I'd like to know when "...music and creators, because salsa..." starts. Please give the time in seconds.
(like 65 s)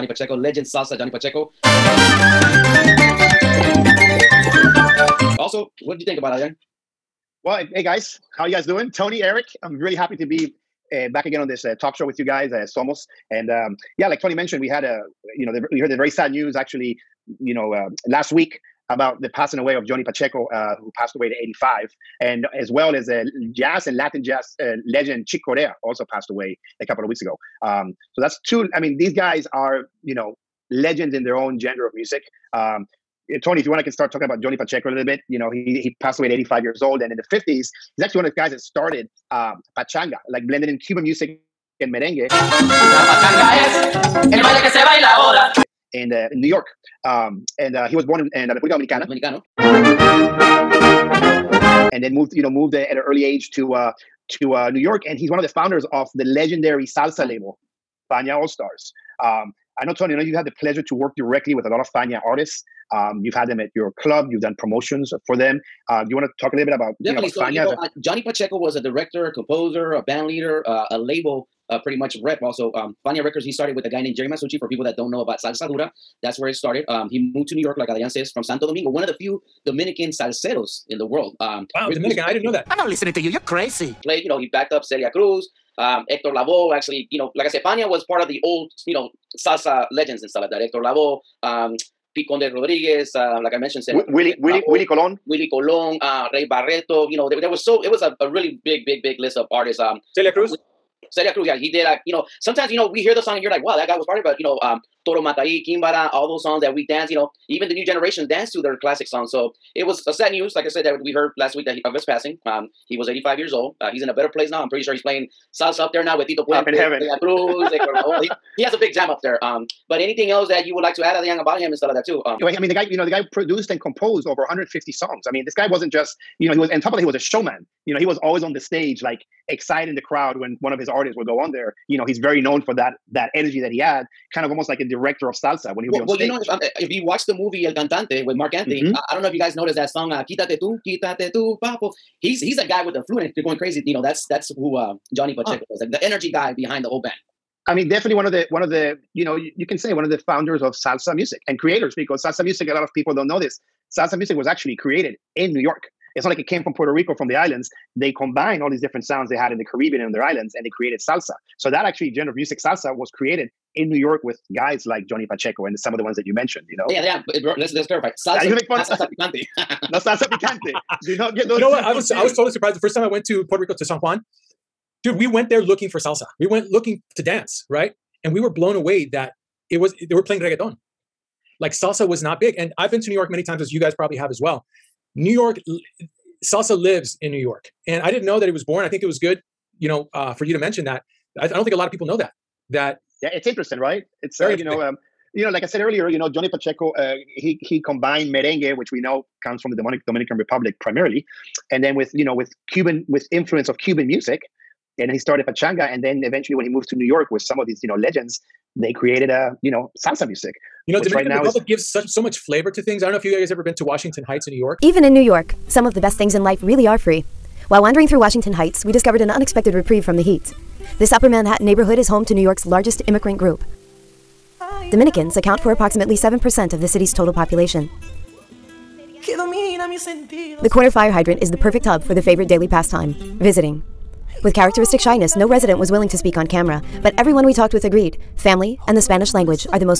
151 s.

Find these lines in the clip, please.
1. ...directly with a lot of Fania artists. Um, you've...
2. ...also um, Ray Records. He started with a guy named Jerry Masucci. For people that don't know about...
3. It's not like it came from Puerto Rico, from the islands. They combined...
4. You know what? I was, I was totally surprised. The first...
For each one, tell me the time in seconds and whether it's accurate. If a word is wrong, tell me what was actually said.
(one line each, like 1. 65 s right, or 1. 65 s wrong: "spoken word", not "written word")
1. 61 s right
2. 72 s wrong: "Fania", not "Ray"
3. 156 s right
4. 171 s right.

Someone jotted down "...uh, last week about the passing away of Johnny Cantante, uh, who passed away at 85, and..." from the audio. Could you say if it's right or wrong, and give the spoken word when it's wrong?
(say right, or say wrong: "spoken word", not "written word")
wrong: "Pacheco", not "Cantante".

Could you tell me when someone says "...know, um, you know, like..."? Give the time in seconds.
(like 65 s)
194 s.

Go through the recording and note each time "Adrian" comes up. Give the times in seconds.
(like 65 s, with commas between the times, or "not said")
6 s, 77 s, 121 s.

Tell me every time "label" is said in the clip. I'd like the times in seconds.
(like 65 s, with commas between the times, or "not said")
57 s, 70 s.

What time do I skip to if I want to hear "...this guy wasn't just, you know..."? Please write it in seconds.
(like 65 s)
125 s.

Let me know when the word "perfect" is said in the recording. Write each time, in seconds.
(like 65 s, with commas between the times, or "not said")
231 s.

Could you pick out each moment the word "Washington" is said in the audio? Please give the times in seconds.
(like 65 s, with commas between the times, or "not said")
213 s, 218 s.